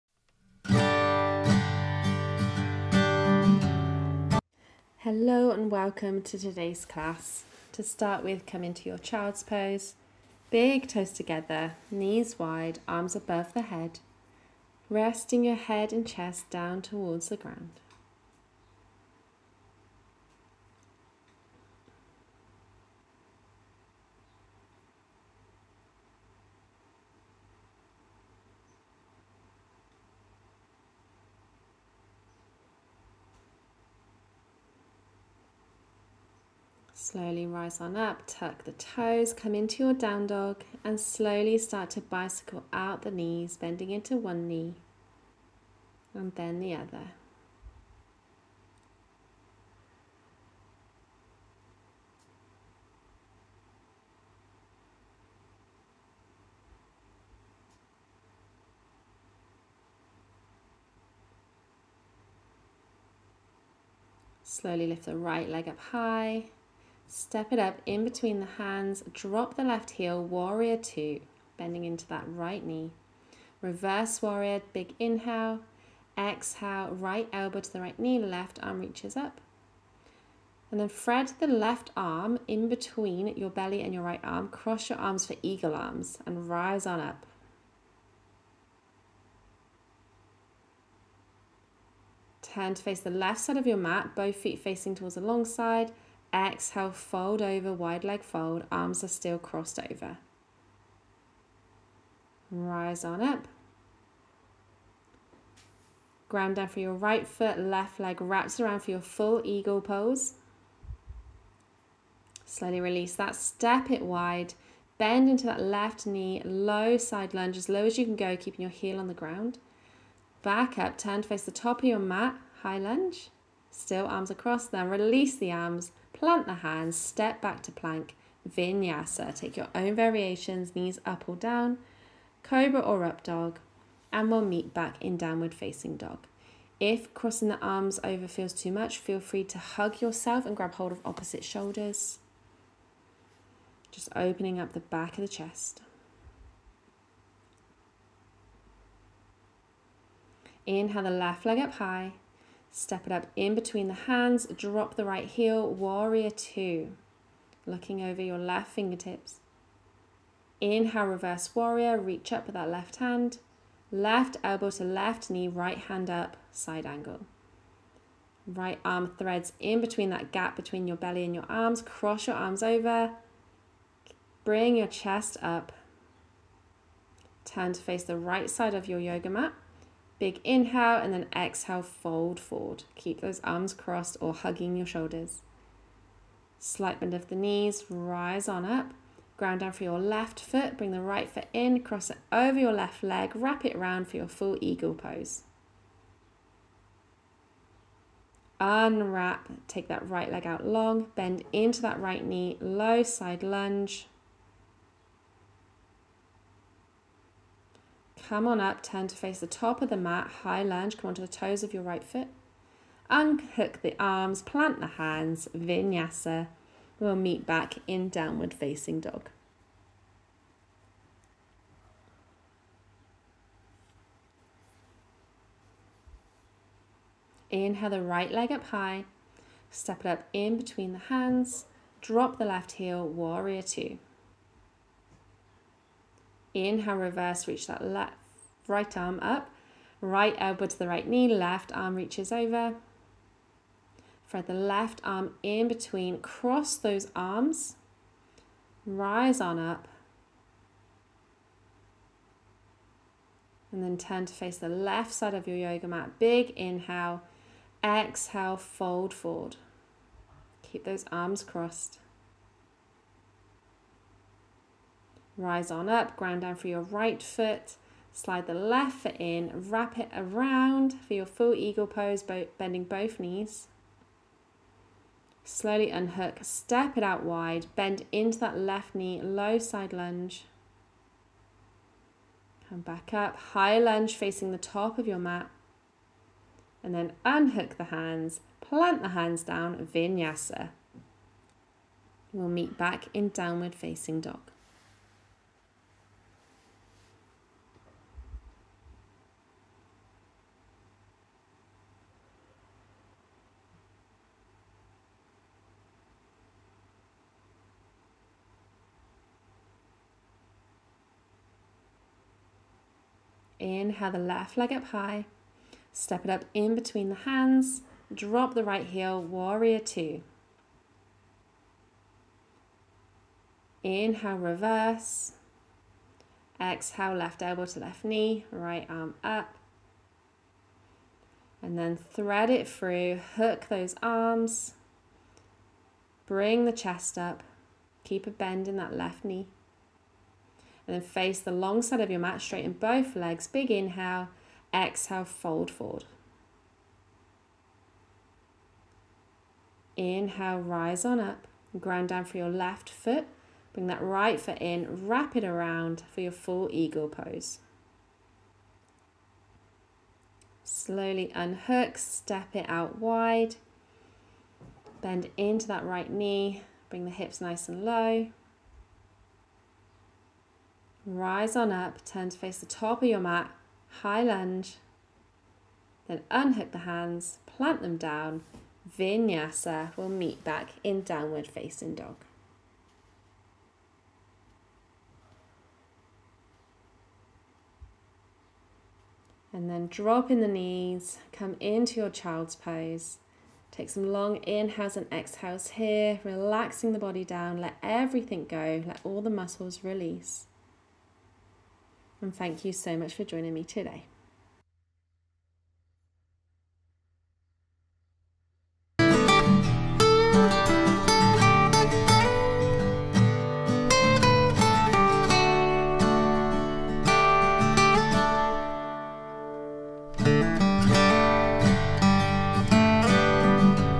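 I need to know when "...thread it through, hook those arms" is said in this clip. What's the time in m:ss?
5:31.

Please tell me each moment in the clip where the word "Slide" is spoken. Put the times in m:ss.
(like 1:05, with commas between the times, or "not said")
4:28.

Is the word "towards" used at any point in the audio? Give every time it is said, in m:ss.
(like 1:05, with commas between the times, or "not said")
0:16, 1:34.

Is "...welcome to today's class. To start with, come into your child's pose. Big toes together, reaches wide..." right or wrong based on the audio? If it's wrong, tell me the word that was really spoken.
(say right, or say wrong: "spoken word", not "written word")
wrong: "knees", not "reaches".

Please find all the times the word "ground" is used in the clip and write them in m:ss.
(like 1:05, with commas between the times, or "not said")
0:17, 1:46, 1:59, 3:09, 4:26, 5:51.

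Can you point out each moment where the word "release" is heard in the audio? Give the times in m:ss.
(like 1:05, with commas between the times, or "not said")
1:52, 2:04, 6:39.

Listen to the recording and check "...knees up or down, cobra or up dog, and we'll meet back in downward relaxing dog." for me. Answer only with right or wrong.
wrong.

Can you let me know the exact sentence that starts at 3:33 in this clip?
Unhook the arms, plant the hands, vinyasa.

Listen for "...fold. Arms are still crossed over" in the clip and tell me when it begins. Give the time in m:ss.
1:38.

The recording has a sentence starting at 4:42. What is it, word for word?
Come back up, high lunge facing the top of your mat.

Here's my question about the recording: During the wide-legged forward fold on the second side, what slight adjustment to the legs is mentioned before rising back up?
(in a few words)
Slight bend of the knees.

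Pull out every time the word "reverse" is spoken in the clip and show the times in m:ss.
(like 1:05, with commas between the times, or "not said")
1:13, 2:41, 3:56, 5:24.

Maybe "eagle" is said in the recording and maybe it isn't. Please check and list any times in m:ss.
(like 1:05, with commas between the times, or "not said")
1:25, 1:49, 3:14, 4:31, 5:56.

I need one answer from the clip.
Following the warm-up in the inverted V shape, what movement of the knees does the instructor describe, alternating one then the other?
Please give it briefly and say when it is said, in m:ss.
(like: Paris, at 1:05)
Bicycle out the knees, at 0:41.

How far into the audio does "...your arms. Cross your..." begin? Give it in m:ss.
2:51.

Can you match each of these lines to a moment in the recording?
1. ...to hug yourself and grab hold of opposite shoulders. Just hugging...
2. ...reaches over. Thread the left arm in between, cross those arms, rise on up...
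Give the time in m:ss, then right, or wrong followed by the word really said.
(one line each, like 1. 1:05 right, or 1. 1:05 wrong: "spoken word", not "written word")
1. 2:19 wrong: "opening", not "hugging"
2. 4:01 right.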